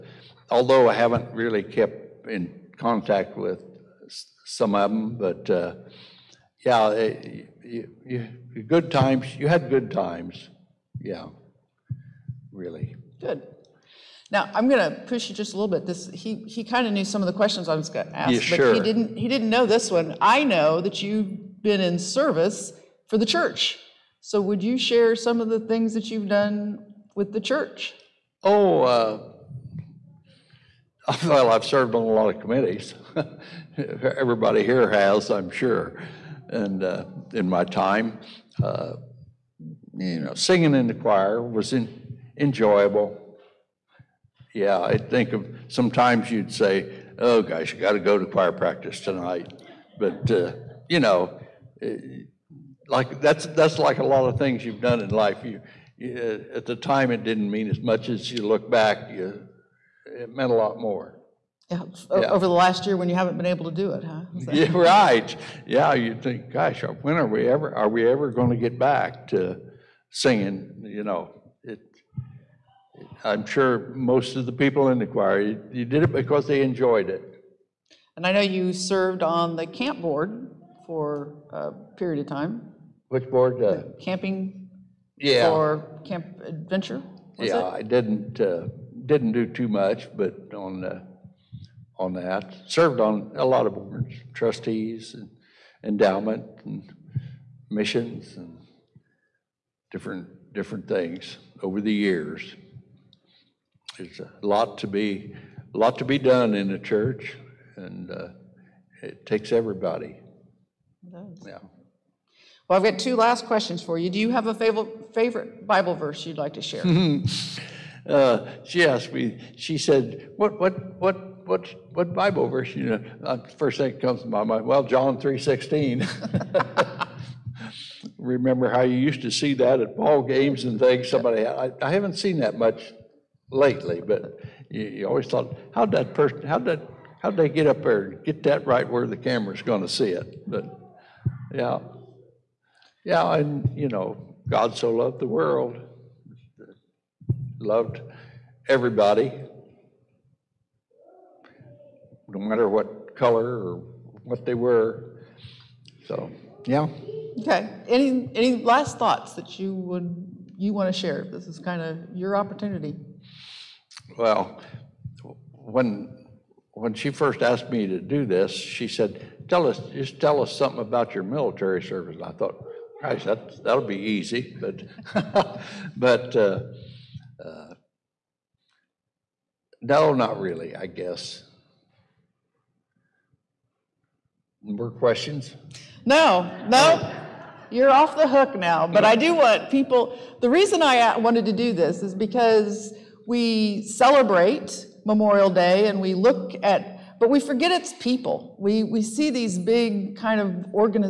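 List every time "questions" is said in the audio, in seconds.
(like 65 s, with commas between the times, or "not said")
17 s, 113 s, 184 s.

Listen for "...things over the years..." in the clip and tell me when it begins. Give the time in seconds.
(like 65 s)
100 s.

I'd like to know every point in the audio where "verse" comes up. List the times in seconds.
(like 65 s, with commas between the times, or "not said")
115 s, 122 s.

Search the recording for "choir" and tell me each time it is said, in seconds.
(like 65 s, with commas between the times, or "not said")
40 s, 48 s, 75 s.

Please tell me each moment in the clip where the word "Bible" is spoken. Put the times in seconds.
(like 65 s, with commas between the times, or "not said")
115 s, 122 s.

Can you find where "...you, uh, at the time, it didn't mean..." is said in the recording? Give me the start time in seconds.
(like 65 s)
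55 s.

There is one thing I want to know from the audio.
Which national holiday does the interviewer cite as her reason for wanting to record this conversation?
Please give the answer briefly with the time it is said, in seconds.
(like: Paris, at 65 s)
Memorial Day, at 195 s.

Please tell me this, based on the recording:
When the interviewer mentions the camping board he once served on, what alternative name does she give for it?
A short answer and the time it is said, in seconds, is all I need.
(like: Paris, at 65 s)
Camp Adventure, at 86 s.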